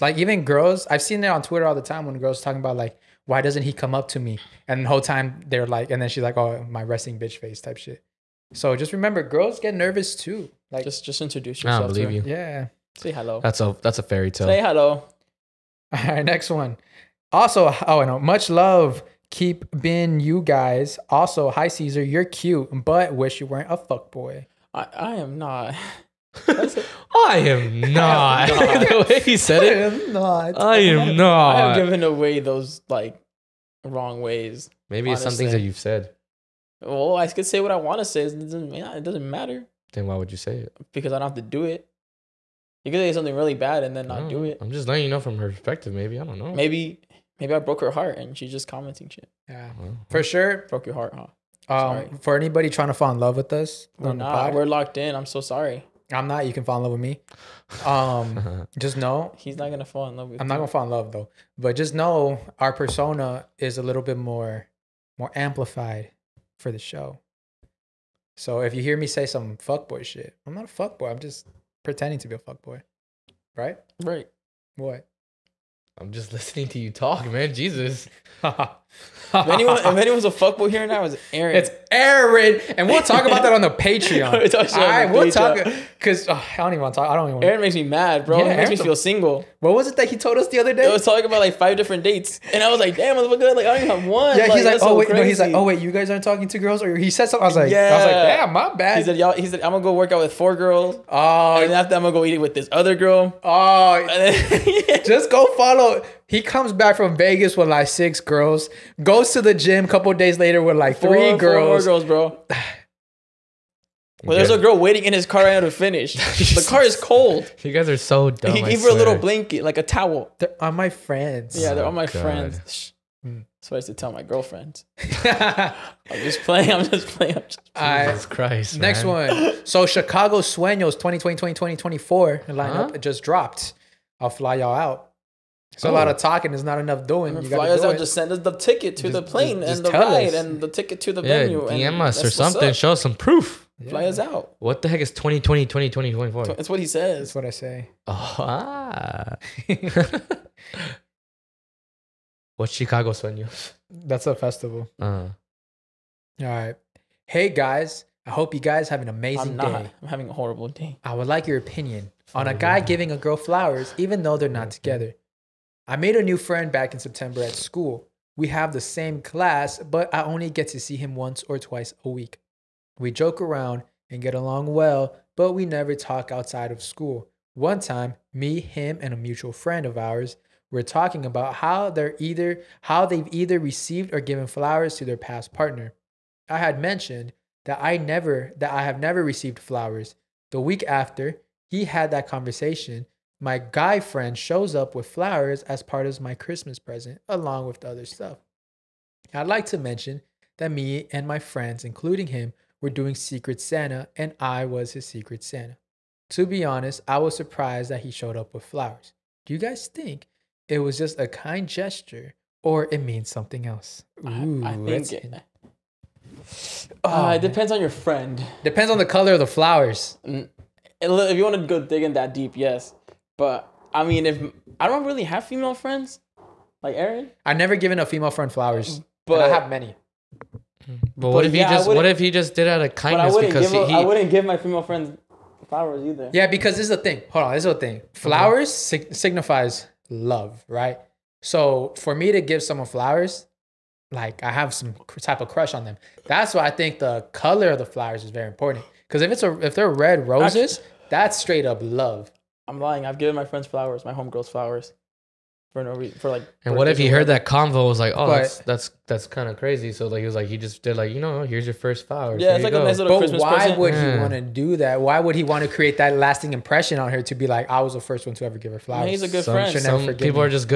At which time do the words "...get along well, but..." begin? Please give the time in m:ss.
2:54.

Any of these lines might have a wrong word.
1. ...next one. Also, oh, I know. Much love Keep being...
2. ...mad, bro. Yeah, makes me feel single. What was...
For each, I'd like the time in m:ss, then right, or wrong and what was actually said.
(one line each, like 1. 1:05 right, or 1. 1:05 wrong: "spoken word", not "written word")
1. 0:16 right
2. 1:27 right.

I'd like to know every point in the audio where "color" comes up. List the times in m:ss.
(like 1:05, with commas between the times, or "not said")
3:39, 4:07.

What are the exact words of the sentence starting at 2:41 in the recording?
I would like your opinion on a guy giving a girl flowers even though they're not together.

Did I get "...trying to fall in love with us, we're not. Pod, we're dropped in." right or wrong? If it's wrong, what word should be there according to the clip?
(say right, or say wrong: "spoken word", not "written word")
wrong: "locked", not "dropped".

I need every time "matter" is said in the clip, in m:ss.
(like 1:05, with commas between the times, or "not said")
0:39.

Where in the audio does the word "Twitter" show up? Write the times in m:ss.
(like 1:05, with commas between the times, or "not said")
0:01.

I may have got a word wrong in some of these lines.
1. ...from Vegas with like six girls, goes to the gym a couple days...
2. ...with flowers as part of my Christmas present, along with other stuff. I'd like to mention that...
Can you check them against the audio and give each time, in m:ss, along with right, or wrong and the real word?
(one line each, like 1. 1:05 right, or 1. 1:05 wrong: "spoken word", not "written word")
1. 1:46 right
2. 3:14 right.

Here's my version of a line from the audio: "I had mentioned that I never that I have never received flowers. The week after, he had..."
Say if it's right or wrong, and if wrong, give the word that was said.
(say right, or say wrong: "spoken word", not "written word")
right.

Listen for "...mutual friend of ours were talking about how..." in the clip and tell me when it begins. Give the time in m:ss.
2:59.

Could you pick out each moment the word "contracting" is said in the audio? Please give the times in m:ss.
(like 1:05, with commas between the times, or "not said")
not said.